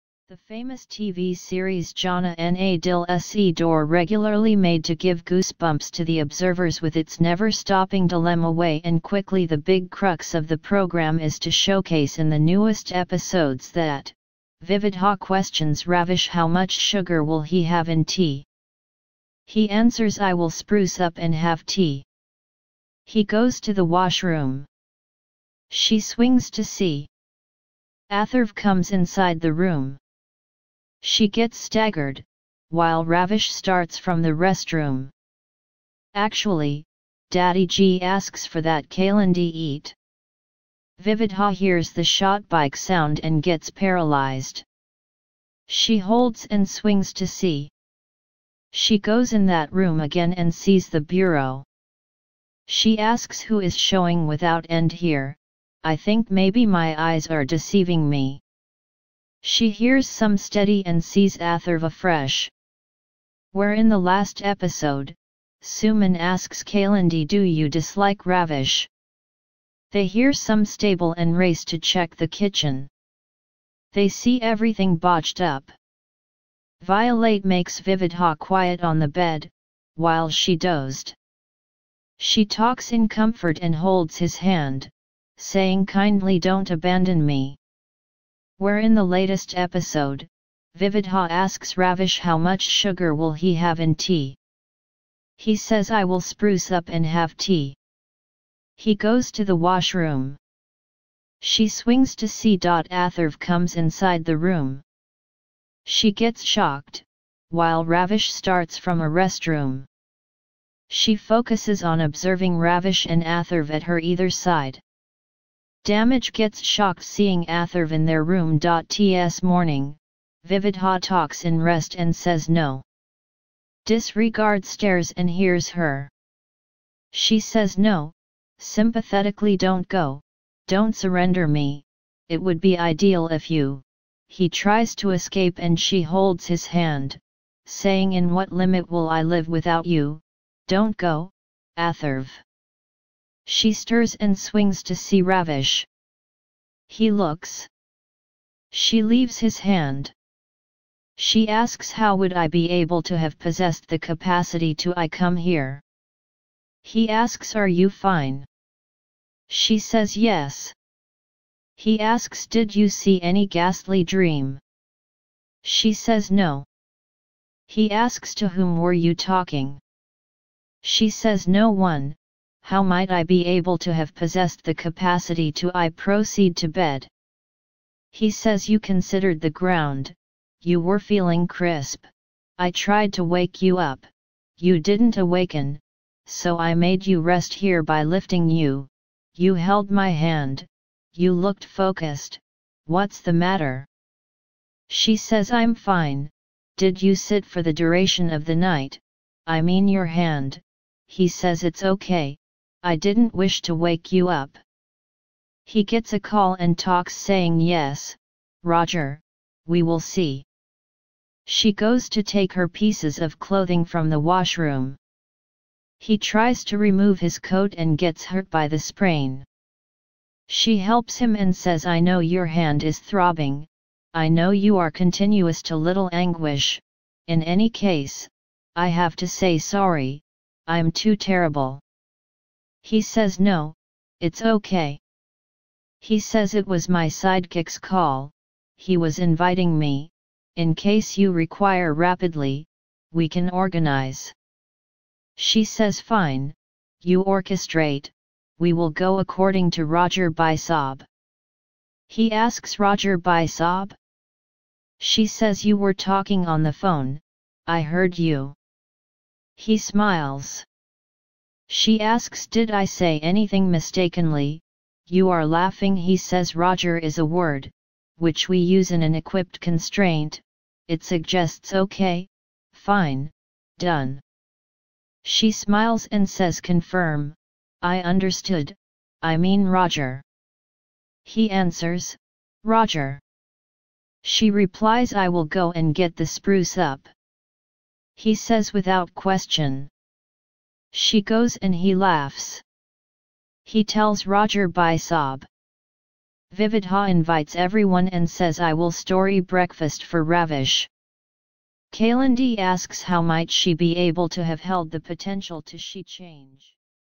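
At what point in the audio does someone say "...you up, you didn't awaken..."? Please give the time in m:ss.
3:03.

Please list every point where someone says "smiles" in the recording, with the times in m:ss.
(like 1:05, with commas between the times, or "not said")
4:19, 4:35.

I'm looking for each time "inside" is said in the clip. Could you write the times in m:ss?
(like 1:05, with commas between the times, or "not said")
0:28, 1:43.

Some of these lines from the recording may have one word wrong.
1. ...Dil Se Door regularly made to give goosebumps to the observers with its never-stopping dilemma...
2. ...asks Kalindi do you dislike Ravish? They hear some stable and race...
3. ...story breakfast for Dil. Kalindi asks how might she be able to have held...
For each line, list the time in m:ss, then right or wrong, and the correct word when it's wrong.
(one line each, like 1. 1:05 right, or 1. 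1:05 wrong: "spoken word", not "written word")
1. 0:02 right
2. 1:06 right
3. 4:58 wrong: "Ravish", not "Dil".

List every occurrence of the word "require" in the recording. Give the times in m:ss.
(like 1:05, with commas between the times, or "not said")
4:01.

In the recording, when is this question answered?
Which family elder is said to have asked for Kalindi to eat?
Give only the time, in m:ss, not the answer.
0:37.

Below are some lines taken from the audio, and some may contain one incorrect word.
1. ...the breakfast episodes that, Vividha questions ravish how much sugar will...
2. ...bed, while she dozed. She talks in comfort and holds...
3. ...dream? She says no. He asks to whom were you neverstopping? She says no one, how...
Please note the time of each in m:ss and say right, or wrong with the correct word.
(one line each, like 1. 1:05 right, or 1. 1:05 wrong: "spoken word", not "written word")
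1. 0:12 wrong: "newest", not "breakfast"
2. 1:19 right
3. 2:44 wrong: "talking", not "neverstopping".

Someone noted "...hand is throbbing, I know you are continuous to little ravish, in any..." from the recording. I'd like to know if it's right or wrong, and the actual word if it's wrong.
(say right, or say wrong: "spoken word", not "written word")
wrong: "anguish", not "ravish".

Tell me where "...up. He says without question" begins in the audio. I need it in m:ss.
4:46.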